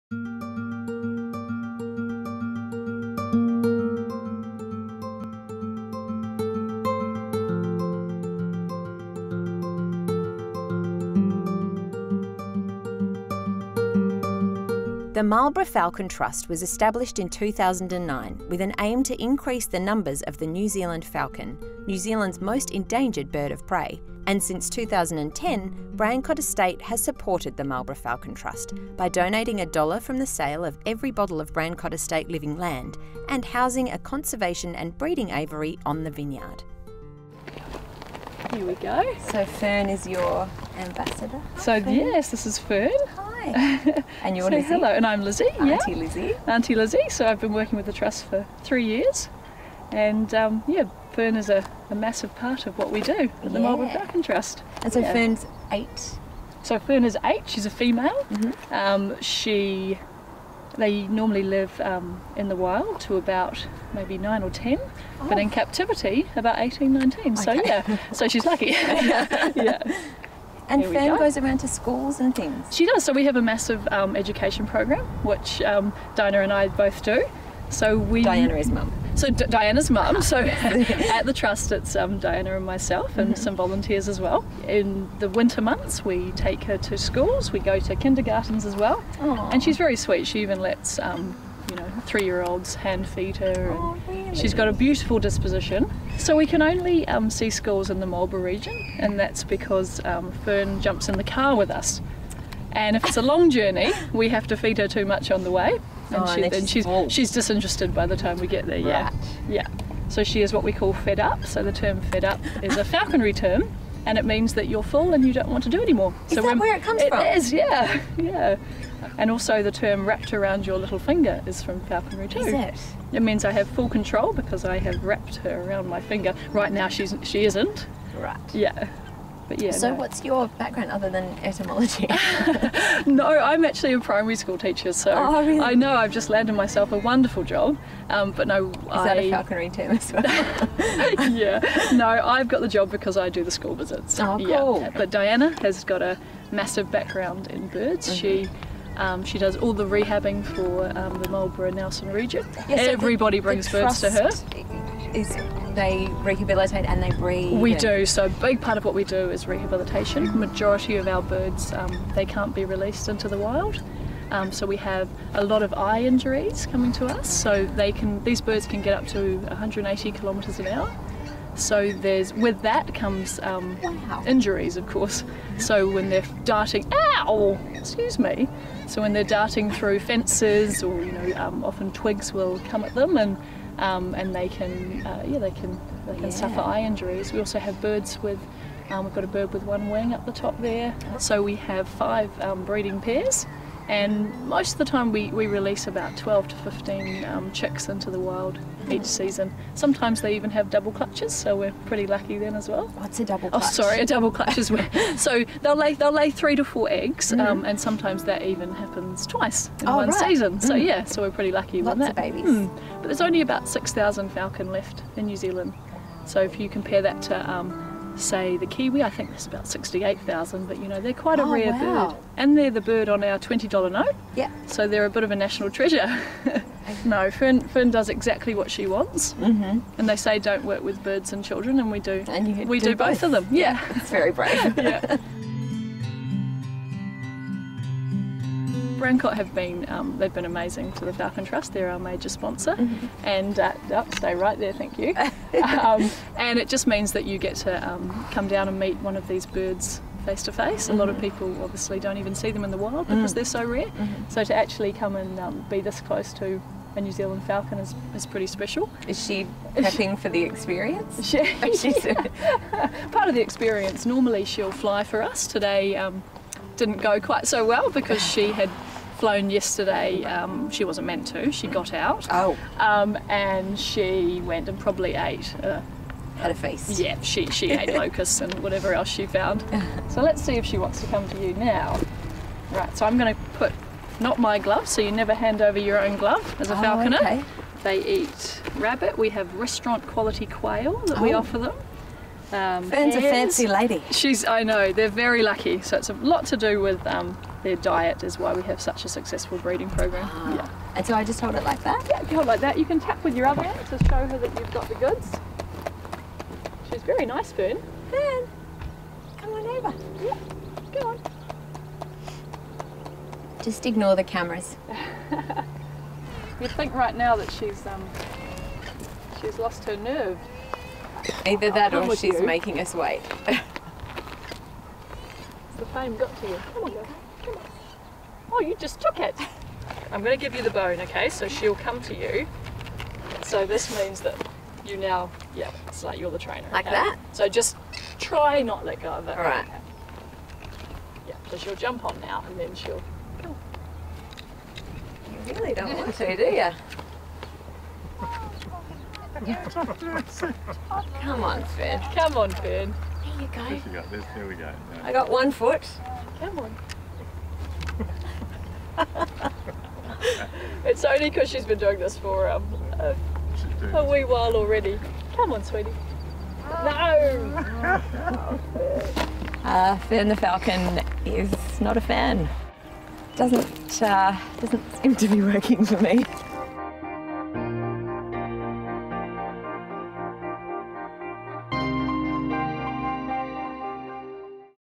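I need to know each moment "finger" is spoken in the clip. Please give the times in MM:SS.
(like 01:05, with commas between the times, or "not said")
02:00, 02:06.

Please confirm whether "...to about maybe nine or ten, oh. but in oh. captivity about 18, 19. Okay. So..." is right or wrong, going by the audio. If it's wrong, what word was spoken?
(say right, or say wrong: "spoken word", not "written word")
right.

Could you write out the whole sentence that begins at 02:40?
Majority of our birds, um, they can't be released into the wild.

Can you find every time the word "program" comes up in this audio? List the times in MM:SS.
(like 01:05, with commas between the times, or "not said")
01:14, 04:59.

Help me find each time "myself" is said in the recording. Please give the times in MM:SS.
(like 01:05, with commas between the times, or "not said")
01:22, 02:16.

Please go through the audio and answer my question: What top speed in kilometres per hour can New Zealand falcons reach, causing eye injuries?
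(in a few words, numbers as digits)
180.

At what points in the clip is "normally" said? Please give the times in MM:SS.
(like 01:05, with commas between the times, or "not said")
01:01, 04:24.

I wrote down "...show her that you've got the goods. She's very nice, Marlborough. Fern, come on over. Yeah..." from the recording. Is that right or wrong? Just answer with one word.
wrong.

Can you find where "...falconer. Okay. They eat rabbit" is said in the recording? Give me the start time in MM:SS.
04:46.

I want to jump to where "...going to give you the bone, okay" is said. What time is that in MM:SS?
05:30.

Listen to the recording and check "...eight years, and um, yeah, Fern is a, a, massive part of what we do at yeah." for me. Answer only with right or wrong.
wrong.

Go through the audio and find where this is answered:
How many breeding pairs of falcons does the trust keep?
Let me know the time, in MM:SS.
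03:11.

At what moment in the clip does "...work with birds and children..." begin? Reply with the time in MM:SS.
03:50.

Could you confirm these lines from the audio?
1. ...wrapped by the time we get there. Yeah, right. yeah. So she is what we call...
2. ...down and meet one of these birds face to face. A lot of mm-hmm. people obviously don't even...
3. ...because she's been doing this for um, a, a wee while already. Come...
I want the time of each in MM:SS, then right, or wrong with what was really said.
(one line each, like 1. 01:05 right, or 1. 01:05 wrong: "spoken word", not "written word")
1. 01:47 wrong: "disinterested", not "wrapped"
2. 04:08 right
3. 06:01 right.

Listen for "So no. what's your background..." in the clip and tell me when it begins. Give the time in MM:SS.
02:09.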